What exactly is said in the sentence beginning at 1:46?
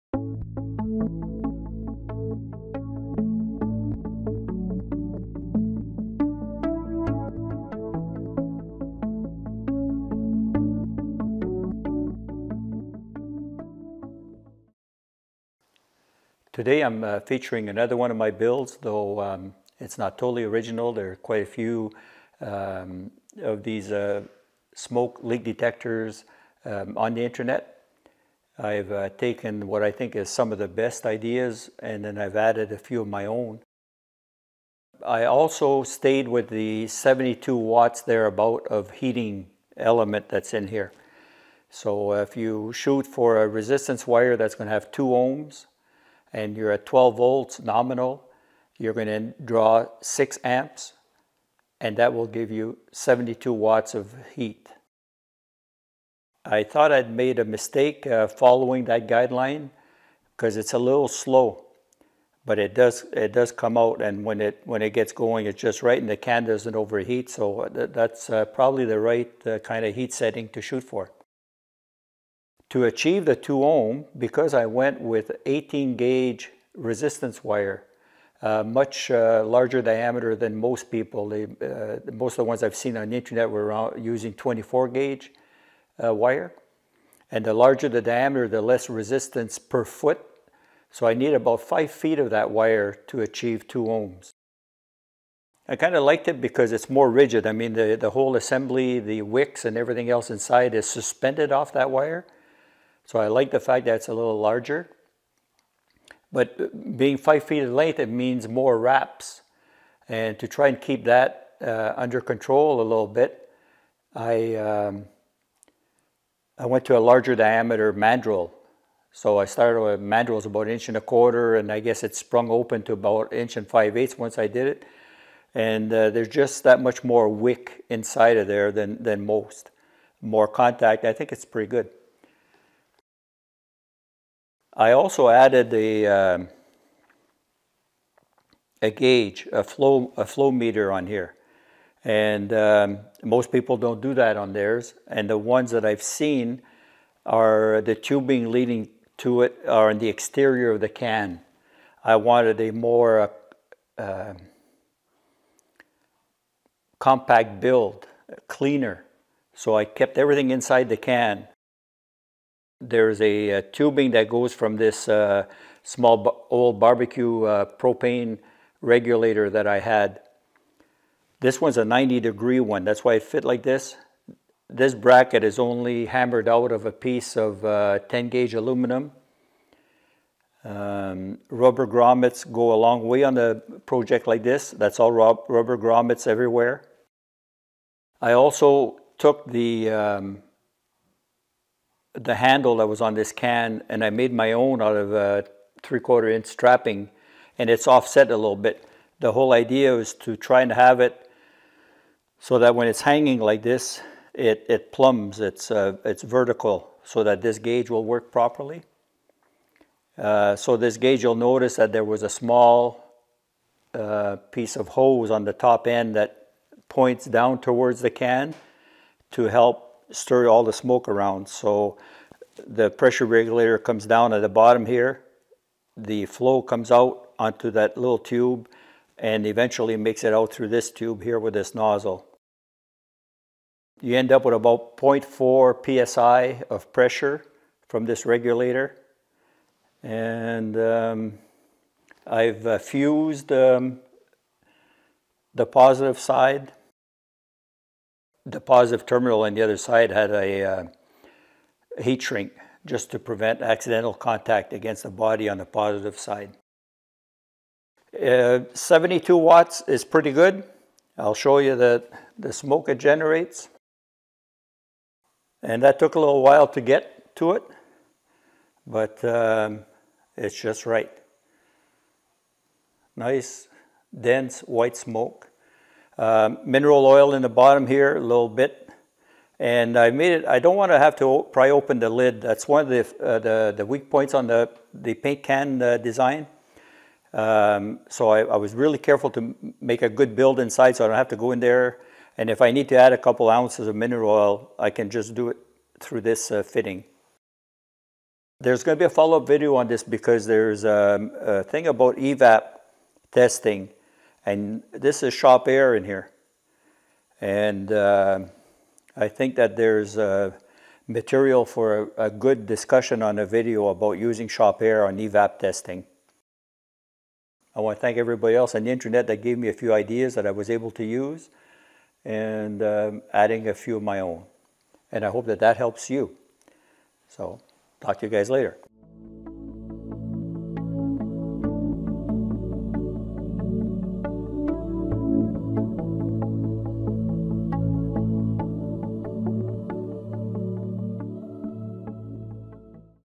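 But being five feet in length, it means more wraps.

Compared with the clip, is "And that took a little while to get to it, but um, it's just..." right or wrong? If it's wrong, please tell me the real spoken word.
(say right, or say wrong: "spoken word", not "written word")
right.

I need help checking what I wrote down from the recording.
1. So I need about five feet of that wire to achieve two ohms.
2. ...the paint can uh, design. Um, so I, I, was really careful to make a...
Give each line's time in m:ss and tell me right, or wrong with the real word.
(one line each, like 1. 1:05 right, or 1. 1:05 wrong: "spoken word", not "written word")
1. 1:30 right
2. 4:44 right.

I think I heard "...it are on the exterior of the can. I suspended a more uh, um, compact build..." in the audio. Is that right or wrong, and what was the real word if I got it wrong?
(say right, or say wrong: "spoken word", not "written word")
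wrong: "wanted", not "suspended".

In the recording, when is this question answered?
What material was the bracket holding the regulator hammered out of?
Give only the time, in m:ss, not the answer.
2:58.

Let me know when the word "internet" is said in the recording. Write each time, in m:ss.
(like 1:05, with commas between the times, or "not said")
0:27, 1:23, 5:18.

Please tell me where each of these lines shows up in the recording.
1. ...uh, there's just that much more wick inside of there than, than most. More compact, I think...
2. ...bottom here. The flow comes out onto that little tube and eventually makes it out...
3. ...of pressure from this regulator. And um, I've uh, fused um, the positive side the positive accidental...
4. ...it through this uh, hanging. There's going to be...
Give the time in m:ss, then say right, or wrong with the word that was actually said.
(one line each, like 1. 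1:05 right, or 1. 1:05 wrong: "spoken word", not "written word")
1. 2:05 wrong: "contact", not "compact"
2. 3:44 right
3. 3:56 wrong: "terminal", not "accidental"
4. 4:55 wrong: "fitting", not "hanging".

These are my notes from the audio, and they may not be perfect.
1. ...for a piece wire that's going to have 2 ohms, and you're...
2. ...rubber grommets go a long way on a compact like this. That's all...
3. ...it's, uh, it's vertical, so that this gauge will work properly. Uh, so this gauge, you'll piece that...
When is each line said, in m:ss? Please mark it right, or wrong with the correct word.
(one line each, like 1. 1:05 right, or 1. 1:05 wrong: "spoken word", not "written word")
1. 0:43 wrong: "resistance", not "piece"
2. 3:01 wrong: "project", not "compact"
3. 3:25 wrong: "notice", not "piece".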